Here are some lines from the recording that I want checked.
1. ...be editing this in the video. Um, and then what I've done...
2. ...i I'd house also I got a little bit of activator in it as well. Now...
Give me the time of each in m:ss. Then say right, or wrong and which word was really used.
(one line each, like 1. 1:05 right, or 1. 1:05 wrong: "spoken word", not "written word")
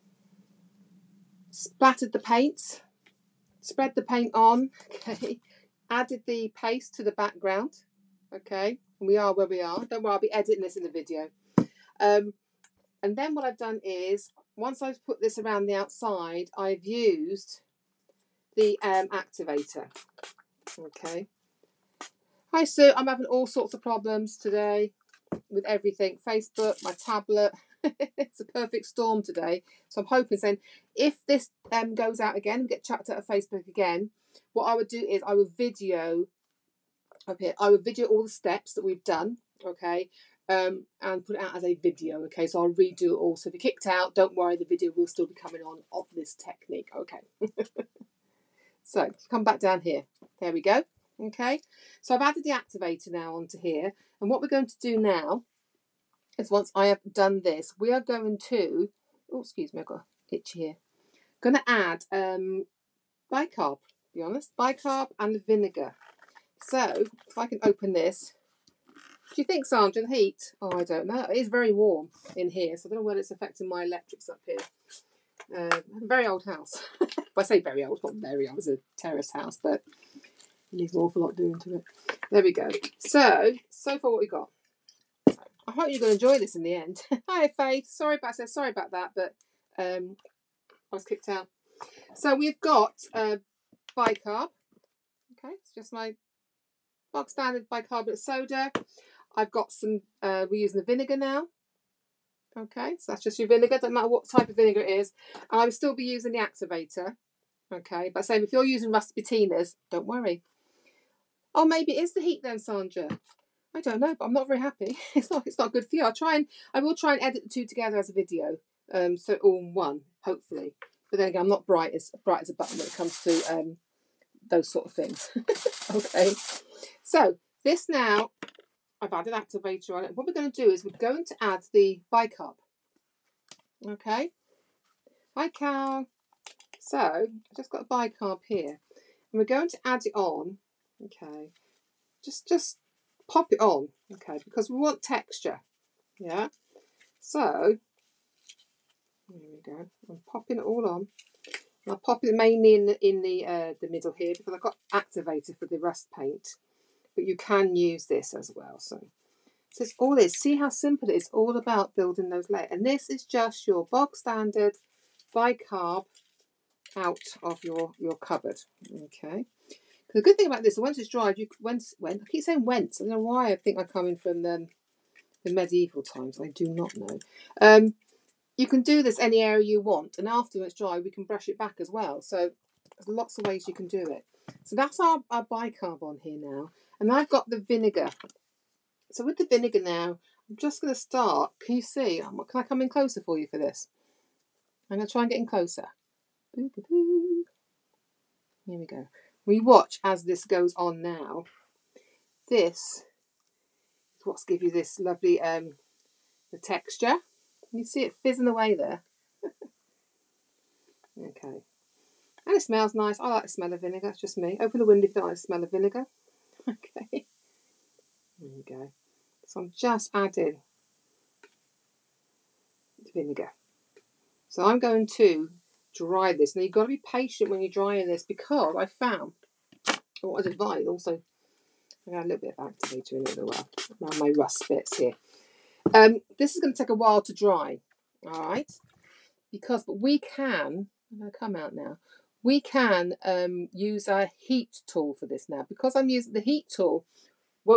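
1. 0:10 right
2. 3:50 wrong: "advise", not "house".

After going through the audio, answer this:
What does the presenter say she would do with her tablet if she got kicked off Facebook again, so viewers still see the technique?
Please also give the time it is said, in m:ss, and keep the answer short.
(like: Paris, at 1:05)
video up here, at 0:35.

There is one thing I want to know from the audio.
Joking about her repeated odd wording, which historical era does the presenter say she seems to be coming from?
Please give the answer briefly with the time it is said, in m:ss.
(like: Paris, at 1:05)
medieval times, at 2:55.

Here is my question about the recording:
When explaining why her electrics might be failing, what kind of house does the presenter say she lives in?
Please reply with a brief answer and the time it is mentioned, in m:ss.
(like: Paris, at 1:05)
terrace house, at 1:18.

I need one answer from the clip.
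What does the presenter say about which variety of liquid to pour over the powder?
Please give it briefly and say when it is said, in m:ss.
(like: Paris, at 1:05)
doesn't matter what type, at 1:43.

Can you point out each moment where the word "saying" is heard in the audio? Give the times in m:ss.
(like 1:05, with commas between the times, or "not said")
0:30, 2:52.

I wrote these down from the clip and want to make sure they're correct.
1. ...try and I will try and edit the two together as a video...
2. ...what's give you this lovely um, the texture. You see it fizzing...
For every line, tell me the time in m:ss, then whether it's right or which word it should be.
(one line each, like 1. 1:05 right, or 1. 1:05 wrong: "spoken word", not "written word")
1. 1:56 right
2. 3:24 right.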